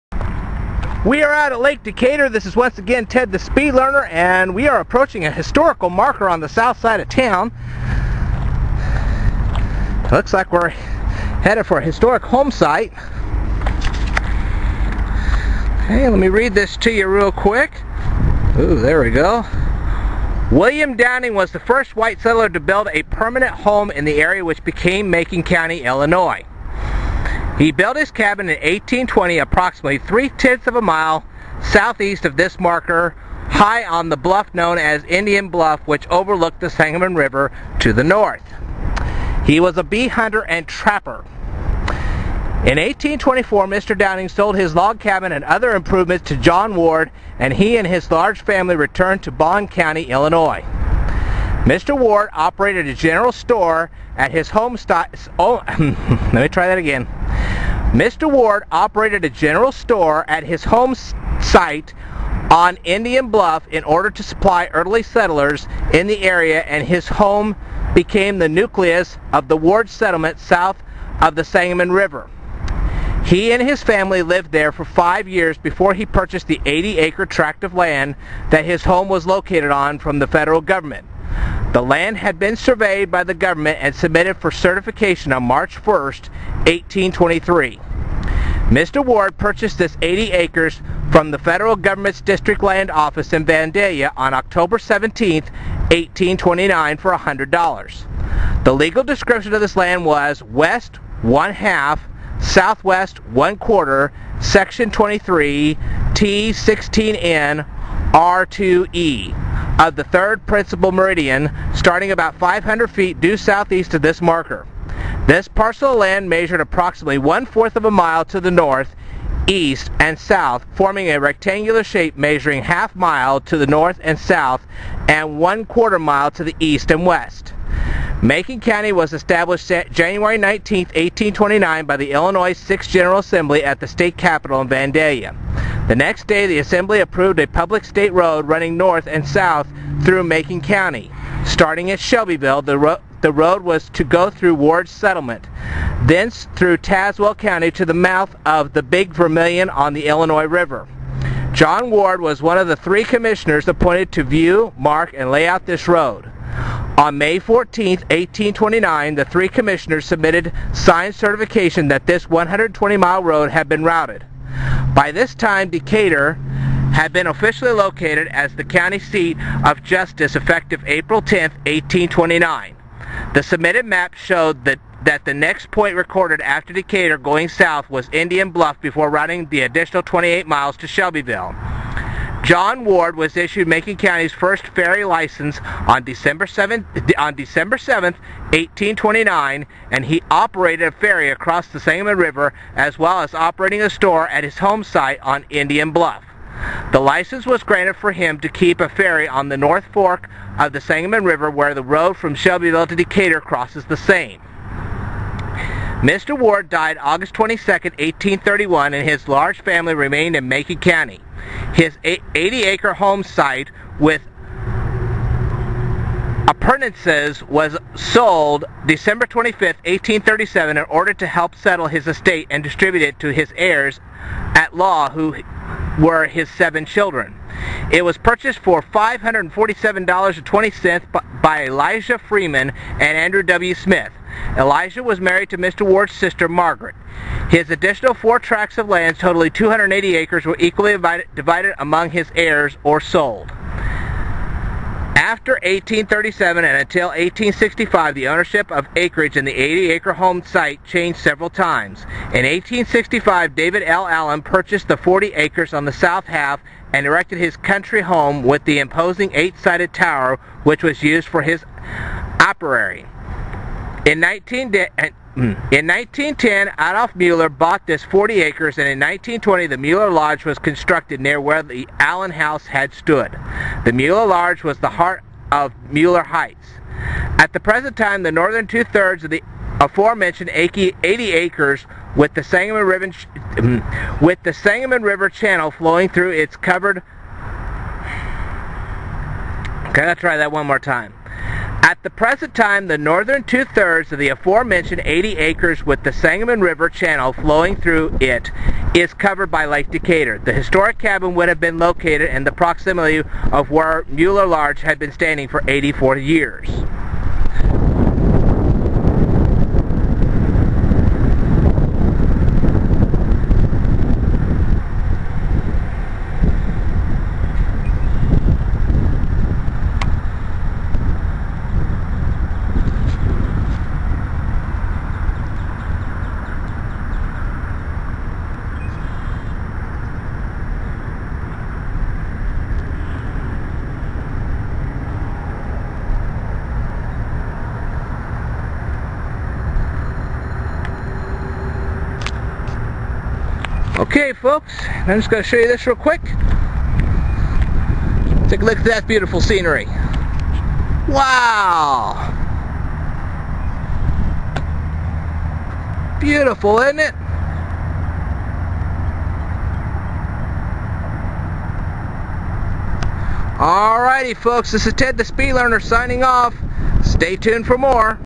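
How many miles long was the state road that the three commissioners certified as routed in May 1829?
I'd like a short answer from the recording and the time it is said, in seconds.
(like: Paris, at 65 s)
120, at 162 s.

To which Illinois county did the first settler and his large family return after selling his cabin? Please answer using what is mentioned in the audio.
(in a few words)
Bond County.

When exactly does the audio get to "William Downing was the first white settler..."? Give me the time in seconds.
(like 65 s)
20 s.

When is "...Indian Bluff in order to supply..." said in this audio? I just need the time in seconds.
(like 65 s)
62 s.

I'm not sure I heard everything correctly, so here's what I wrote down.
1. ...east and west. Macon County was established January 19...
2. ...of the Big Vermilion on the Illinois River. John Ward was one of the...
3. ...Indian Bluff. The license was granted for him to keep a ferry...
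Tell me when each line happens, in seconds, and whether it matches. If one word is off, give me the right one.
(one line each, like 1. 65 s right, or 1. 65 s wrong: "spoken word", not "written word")
1. 126 s right
2. 148 s right
3. 195 s right.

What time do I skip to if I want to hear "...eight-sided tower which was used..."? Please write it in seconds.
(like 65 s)
259 s.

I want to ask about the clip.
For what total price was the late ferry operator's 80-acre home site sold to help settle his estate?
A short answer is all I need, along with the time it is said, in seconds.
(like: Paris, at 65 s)
$547.20, at 228 s.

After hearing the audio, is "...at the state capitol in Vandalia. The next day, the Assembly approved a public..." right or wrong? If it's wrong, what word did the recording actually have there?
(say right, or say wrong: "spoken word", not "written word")
right.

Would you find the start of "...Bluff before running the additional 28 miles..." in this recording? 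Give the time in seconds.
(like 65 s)
178 s.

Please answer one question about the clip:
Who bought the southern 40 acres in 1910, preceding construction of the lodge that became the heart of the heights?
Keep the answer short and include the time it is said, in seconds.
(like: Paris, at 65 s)
Adolf Mueller, at 266 s.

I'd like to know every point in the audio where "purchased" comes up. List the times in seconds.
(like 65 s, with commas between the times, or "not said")
76 s, 89 s, 228 s, 254 s.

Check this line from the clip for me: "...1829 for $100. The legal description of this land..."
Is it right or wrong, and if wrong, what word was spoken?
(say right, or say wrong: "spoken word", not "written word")
right.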